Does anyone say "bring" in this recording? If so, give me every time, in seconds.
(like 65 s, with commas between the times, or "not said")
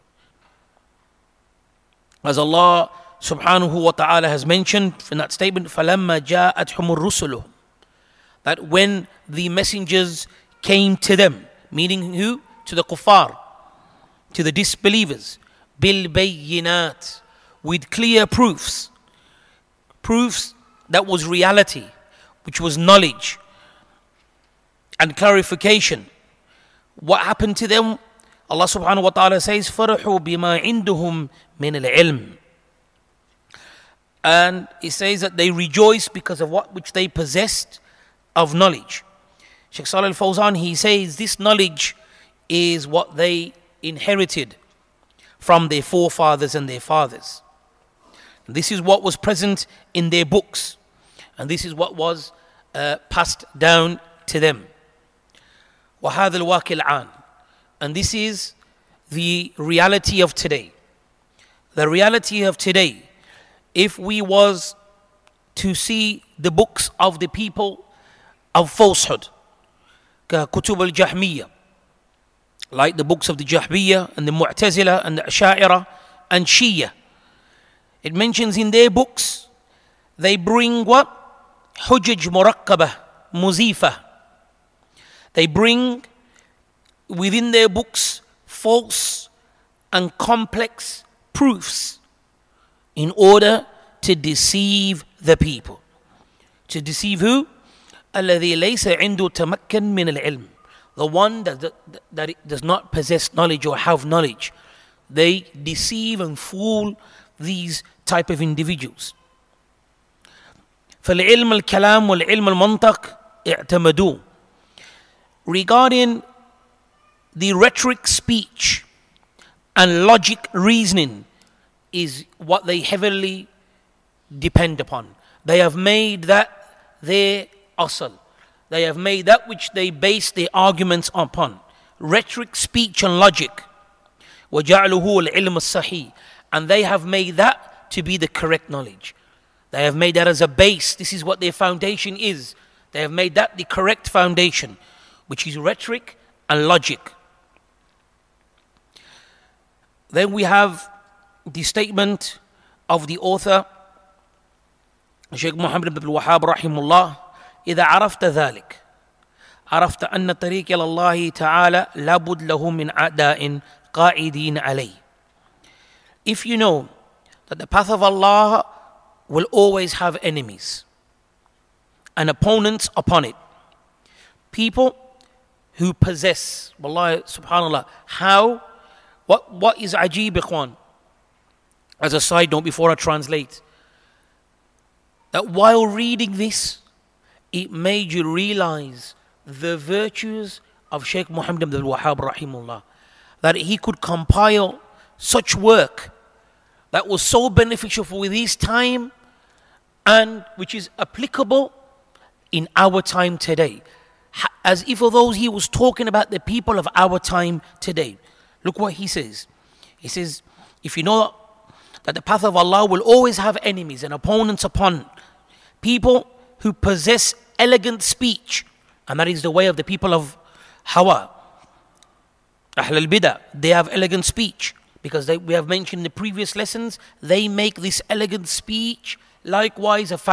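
80 s, 85 s.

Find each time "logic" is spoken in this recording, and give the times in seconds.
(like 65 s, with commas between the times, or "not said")
120 s, 133 s, 146 s.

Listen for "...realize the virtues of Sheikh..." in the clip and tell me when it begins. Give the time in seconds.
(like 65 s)
188 s.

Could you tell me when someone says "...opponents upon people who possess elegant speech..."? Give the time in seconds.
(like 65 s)
214 s.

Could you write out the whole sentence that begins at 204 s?
As if although he was talking about the people of our time today.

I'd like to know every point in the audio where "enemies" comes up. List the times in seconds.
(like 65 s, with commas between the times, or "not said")
170 s, 213 s.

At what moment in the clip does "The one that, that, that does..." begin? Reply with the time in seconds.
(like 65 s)
100 s.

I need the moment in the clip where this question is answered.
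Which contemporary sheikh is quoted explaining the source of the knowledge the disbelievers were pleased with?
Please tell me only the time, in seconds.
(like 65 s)
39 s.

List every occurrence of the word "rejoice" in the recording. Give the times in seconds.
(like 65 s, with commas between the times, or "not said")
35 s.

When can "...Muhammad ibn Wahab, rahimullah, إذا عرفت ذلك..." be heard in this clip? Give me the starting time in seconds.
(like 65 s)
155 s.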